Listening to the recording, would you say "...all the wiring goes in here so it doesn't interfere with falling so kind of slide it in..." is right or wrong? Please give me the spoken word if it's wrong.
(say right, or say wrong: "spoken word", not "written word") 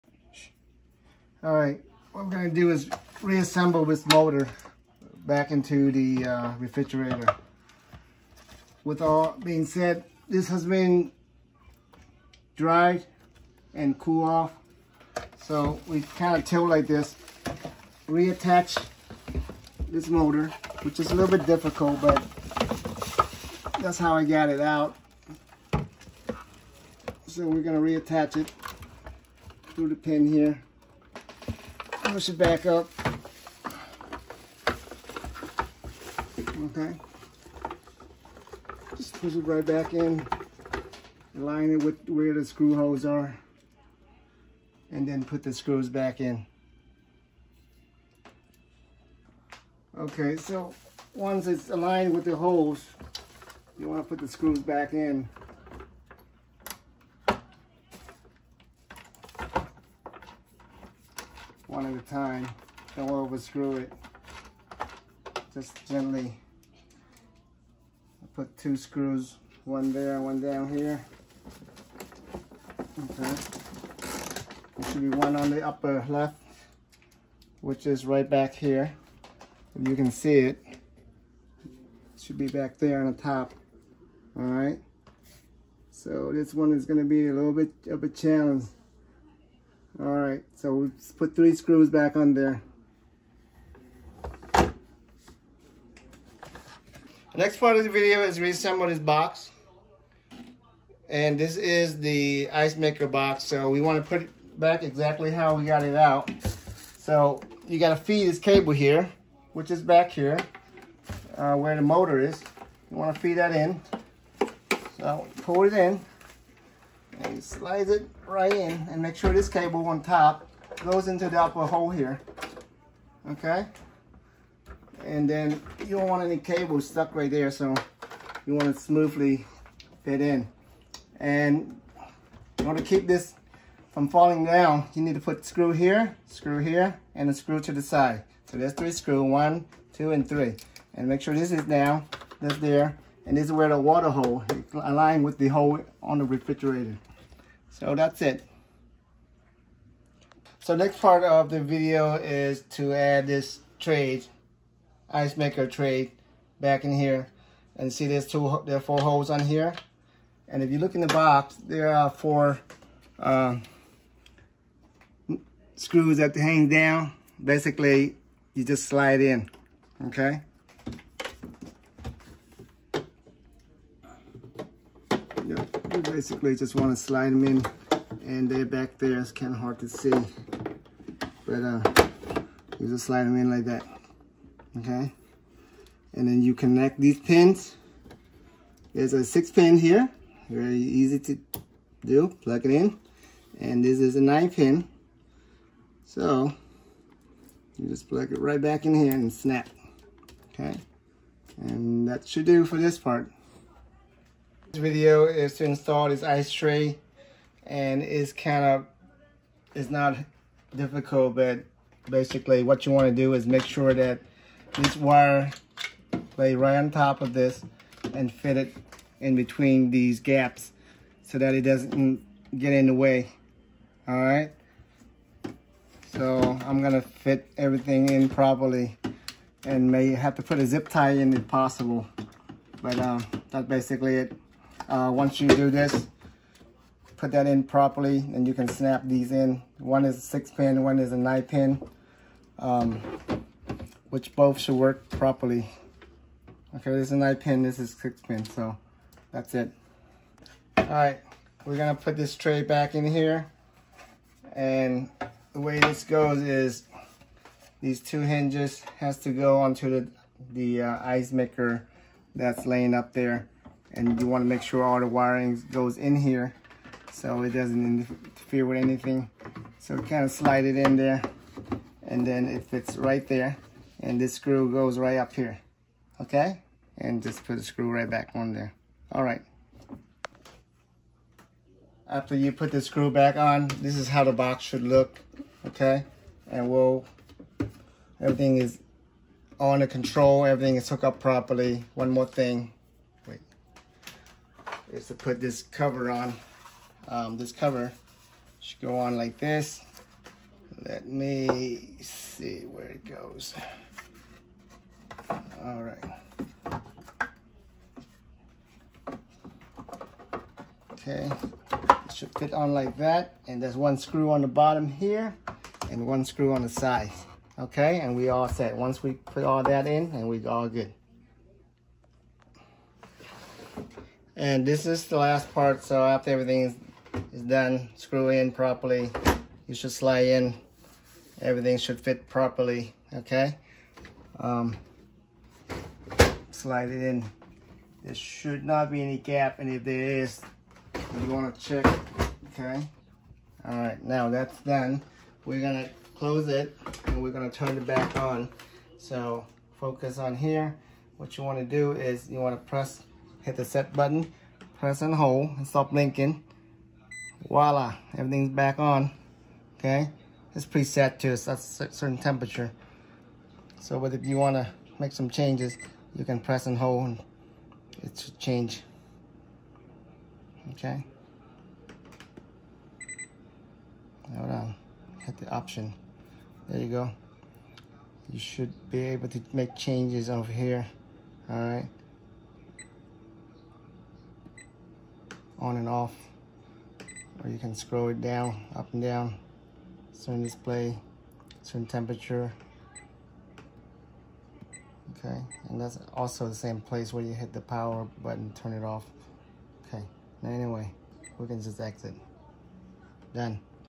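wrong: "anything", not "falling".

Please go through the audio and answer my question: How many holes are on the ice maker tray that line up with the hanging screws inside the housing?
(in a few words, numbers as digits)
4.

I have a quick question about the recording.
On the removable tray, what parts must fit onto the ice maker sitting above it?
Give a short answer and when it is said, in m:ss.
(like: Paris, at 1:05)
two hinges, at 4:18.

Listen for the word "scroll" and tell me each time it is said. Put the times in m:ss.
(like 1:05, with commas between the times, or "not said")
6:27.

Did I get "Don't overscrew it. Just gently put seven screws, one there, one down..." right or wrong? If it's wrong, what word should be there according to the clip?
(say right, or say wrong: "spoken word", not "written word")
wrong: "two", not "seven".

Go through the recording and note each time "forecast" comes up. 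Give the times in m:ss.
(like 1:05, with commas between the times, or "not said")
not said.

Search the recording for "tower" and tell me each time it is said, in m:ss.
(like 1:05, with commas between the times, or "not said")
not said.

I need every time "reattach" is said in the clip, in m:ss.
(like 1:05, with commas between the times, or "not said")
0:18, 0:27.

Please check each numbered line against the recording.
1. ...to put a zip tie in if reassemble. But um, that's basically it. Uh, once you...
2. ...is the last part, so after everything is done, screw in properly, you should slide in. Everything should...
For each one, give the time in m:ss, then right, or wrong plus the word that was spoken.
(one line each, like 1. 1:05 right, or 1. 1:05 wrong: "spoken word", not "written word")
1. 3:50 wrong: "possible", not "reassemble"
2. 5:24 right.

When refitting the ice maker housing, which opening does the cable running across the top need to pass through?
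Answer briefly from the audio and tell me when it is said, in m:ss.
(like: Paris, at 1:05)
upper hole, at 2:01.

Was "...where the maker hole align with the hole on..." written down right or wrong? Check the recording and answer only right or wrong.
wrong.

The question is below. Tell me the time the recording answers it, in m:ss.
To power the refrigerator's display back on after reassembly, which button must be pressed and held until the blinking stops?
5:53.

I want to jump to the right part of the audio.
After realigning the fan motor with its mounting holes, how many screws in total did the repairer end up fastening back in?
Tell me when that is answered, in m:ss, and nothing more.
1:31.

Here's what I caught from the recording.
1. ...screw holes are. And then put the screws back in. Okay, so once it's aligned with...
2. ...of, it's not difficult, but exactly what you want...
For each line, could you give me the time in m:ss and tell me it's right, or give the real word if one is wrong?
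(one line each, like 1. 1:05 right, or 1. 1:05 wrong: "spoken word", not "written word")
1. 0:42 right
2. 3:28 wrong: "basically", not "exactly".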